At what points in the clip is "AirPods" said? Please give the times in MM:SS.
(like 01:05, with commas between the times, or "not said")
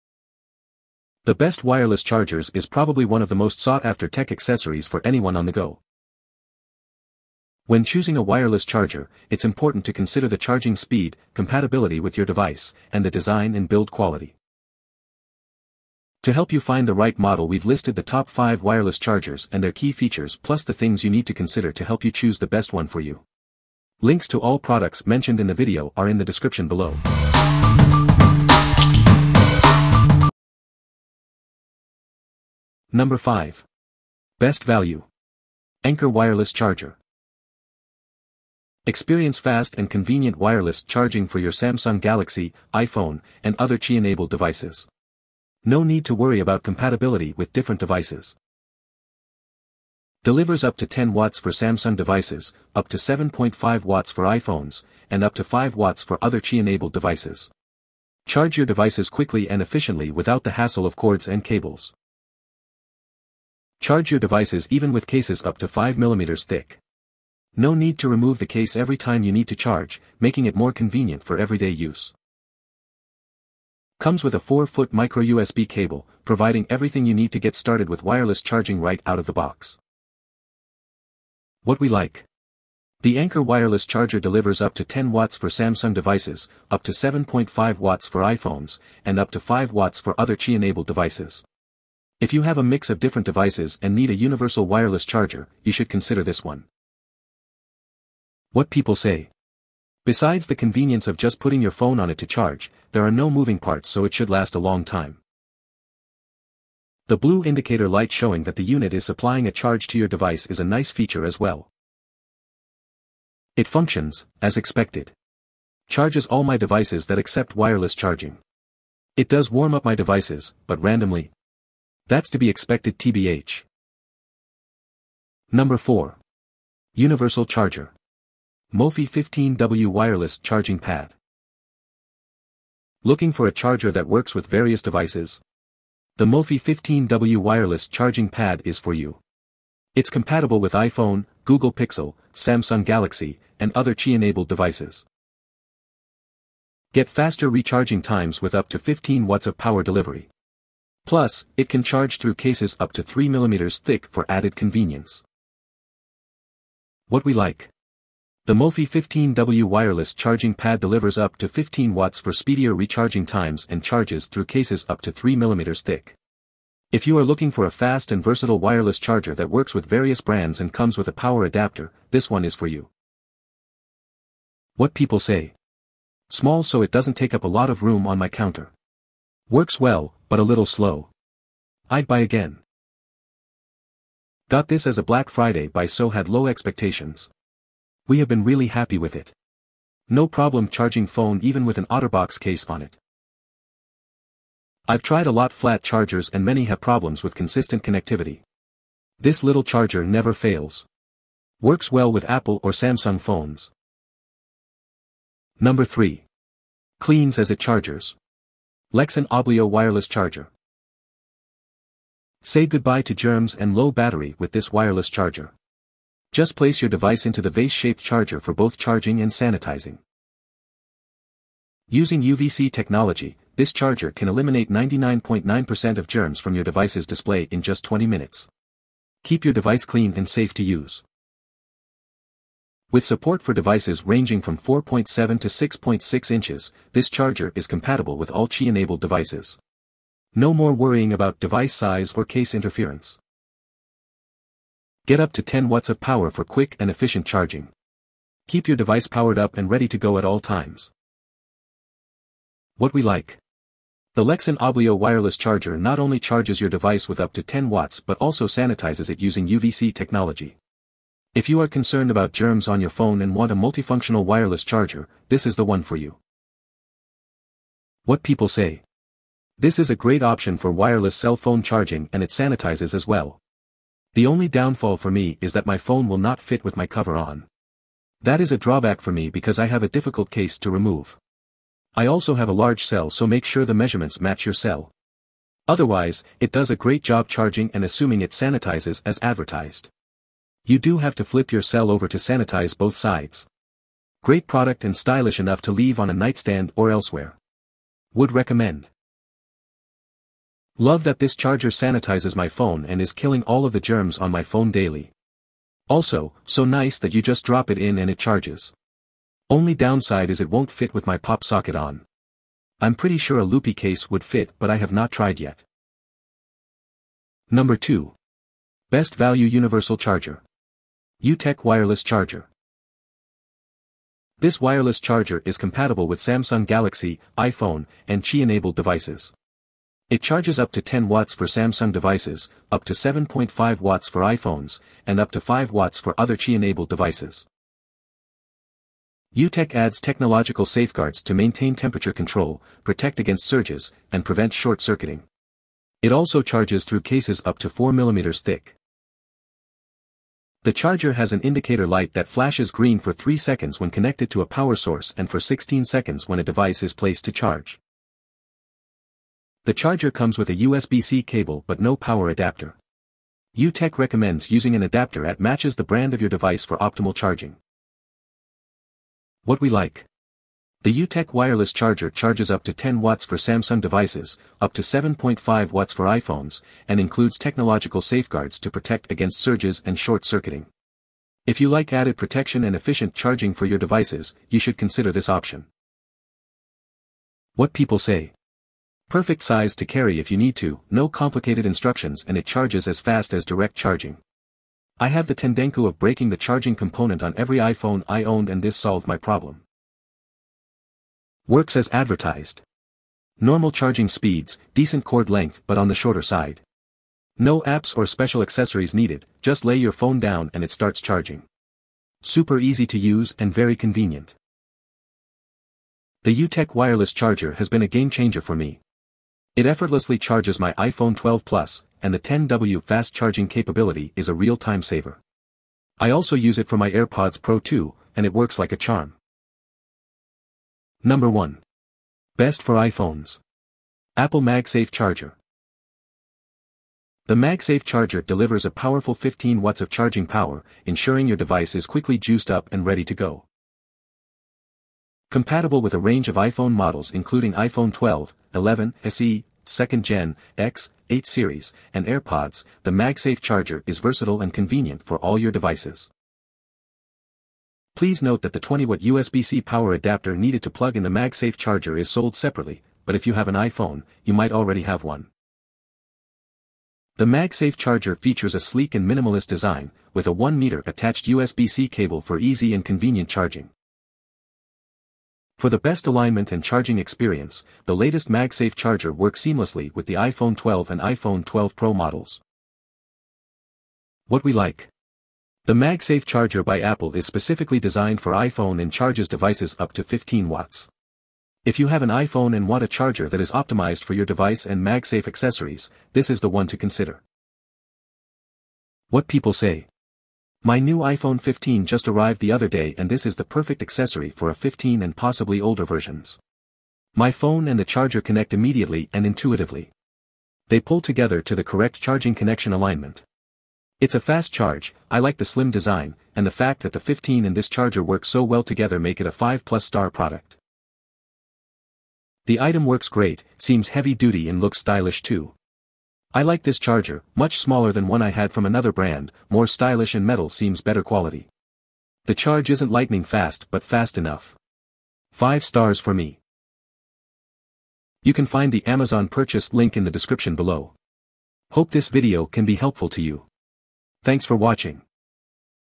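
07:06, 07:32.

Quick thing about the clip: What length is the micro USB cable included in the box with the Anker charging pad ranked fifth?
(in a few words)
4-foot.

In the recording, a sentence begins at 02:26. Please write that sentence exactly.
Get faster recharging times with up to 15 watts of power delivery.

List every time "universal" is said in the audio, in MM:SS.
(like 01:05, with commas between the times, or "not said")
01:34, 02:06, 05:19.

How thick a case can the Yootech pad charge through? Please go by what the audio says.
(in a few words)
4 mm.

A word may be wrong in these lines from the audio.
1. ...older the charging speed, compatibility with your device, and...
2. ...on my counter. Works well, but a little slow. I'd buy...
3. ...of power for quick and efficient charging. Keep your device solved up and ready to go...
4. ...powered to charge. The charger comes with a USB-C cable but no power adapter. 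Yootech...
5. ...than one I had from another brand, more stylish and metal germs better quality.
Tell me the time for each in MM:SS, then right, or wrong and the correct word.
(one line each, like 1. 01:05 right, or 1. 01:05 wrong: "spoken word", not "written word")
1. 00:09 wrong: "consider", not "older"
2. 02:58 right
3. 04:05 wrong: "powered", not "solved"
4. 05:56 wrong: "placed", not "powered"
5. 08:47 wrong: "seems", not "germs".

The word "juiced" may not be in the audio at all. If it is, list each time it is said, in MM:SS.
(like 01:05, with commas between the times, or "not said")
07:22.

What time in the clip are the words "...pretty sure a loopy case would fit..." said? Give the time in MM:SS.
05:12.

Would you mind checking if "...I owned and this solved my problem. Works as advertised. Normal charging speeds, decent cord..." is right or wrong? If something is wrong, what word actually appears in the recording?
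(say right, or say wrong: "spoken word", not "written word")
right.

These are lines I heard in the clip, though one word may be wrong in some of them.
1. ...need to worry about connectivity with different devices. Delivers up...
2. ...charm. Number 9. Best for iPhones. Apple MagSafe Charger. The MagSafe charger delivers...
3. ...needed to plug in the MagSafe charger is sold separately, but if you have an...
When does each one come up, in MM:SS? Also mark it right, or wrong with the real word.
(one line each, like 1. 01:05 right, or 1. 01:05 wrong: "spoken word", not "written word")
1. 00:45 wrong: "compatibility", not "connectivity"
2. 07:08 wrong: "1", not "9"
3. 07:40 right.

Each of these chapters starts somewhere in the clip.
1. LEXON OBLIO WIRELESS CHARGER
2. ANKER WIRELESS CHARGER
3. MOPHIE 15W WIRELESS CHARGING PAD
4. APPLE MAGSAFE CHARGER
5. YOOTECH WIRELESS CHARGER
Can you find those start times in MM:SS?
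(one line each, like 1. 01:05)
1. 03:24
2. 00:31
3. 02:04
4. 07:09
5. 05:16.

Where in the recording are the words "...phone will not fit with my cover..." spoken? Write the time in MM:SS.
04:35.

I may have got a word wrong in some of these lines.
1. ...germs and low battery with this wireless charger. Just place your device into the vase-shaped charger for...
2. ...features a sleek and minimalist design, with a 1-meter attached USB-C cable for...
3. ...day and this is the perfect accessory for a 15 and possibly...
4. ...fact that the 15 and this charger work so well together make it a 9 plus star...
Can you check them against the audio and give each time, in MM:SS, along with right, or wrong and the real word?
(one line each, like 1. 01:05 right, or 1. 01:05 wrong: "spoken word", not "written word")
1. 03:33 right
2. 07:48 right
3. 08:22 right
4. 08:36 wrong: "5", not "9".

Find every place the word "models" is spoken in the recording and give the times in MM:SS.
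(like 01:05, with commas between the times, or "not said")
00:17, 07:26, 08:01.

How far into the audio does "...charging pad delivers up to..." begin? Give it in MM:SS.
02:40.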